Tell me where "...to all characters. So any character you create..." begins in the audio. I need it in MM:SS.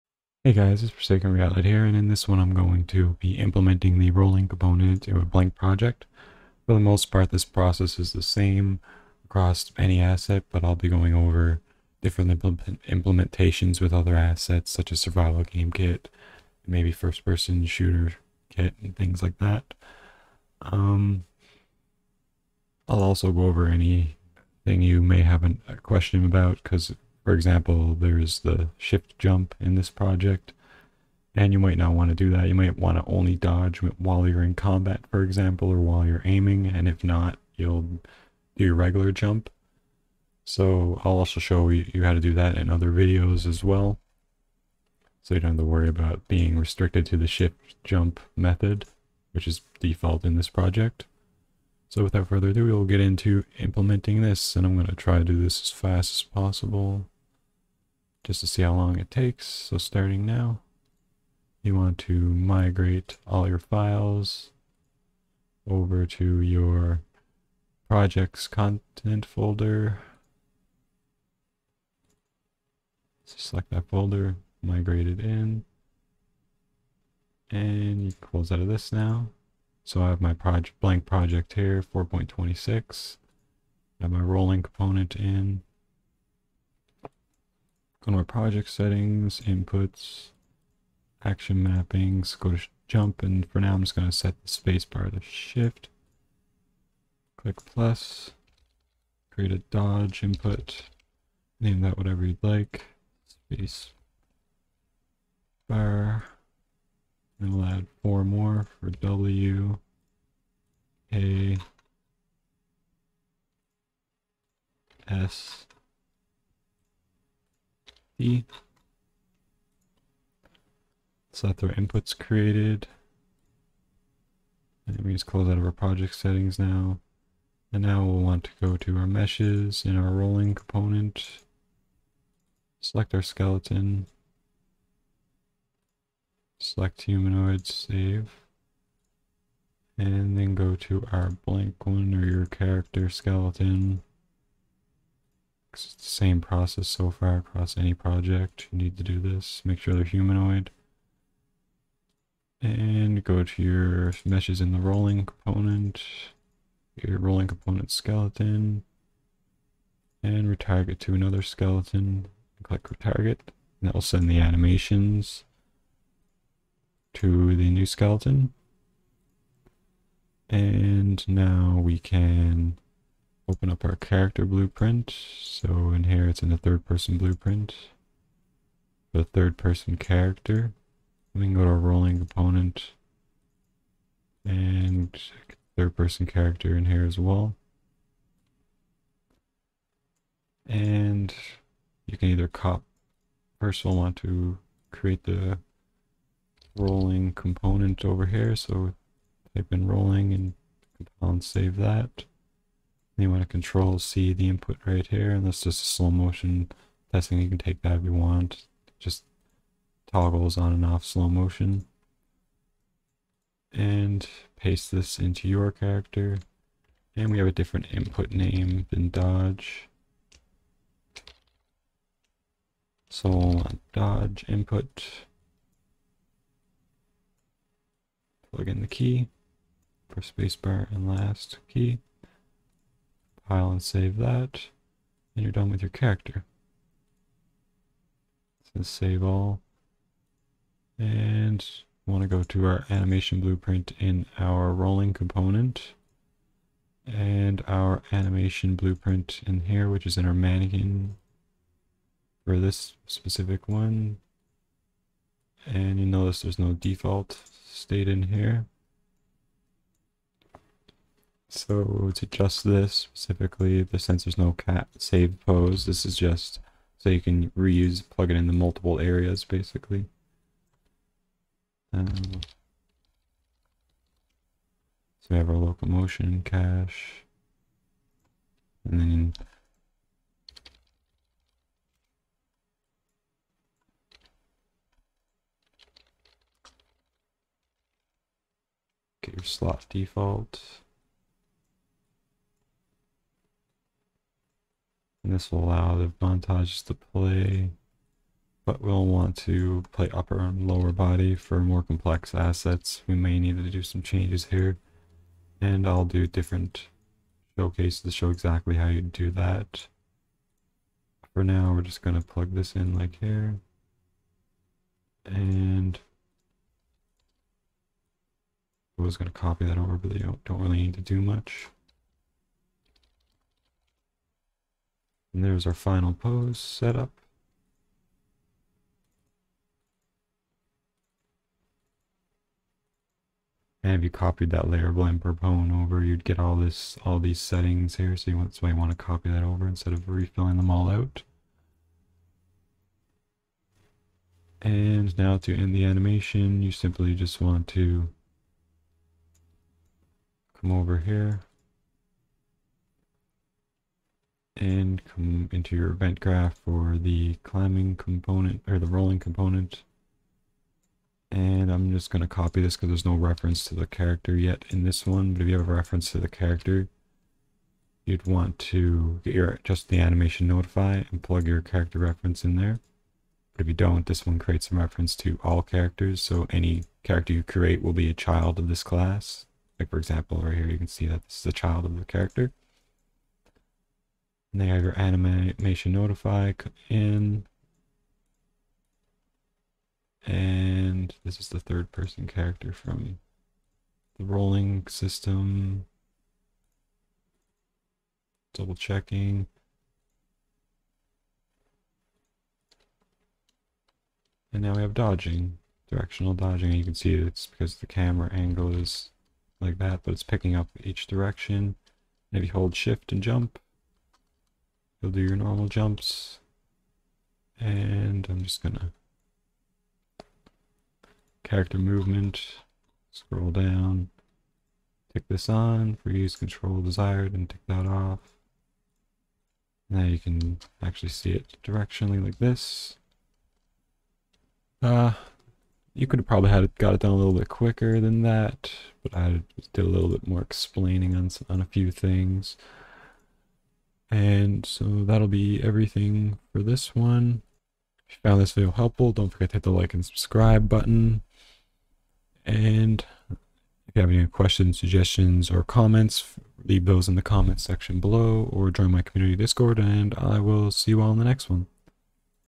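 06:15.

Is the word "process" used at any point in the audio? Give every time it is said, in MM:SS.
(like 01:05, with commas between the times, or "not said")
00:07, 02:26.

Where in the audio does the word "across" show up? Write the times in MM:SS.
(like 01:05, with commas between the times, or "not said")
00:09, 02:27.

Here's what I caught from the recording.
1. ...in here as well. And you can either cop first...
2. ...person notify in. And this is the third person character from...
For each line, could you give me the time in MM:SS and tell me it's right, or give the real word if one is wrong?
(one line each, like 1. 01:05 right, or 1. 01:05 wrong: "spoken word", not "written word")
1. 03:06 right
2. 06:24 wrong: "animation", not "person".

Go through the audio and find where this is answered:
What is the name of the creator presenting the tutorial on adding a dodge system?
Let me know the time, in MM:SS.
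00:00.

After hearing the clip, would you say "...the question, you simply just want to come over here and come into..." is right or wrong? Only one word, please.
wrong.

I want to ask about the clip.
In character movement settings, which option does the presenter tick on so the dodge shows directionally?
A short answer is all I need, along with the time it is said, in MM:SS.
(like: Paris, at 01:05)
Use control desired, at 07:06.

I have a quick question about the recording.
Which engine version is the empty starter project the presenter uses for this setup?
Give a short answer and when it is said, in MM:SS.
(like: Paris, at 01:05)
4.26, at 01:21.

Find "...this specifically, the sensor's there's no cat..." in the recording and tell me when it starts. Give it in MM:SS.
04:22.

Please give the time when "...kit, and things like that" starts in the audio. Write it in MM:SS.
00:18.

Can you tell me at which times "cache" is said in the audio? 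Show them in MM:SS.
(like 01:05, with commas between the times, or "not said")
04:36.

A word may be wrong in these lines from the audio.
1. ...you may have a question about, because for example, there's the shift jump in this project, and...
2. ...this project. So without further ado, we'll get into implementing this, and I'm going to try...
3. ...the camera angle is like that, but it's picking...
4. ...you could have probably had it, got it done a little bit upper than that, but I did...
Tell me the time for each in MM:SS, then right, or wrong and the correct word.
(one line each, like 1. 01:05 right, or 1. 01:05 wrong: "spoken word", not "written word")
1. 00:24 right
2. 00:50 right
3. 06:47 right
4. 07:15 wrong: "quicker", not "upper".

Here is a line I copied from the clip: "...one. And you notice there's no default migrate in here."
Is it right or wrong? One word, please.
wrong.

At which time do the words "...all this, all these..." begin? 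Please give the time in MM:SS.
05:36.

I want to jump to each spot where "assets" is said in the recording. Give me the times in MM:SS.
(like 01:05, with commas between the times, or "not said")
00:10, 00:14, 05:02.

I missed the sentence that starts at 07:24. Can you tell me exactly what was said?
And so that'll be everything for this one.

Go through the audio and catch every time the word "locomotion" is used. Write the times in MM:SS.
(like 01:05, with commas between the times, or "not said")
04:35.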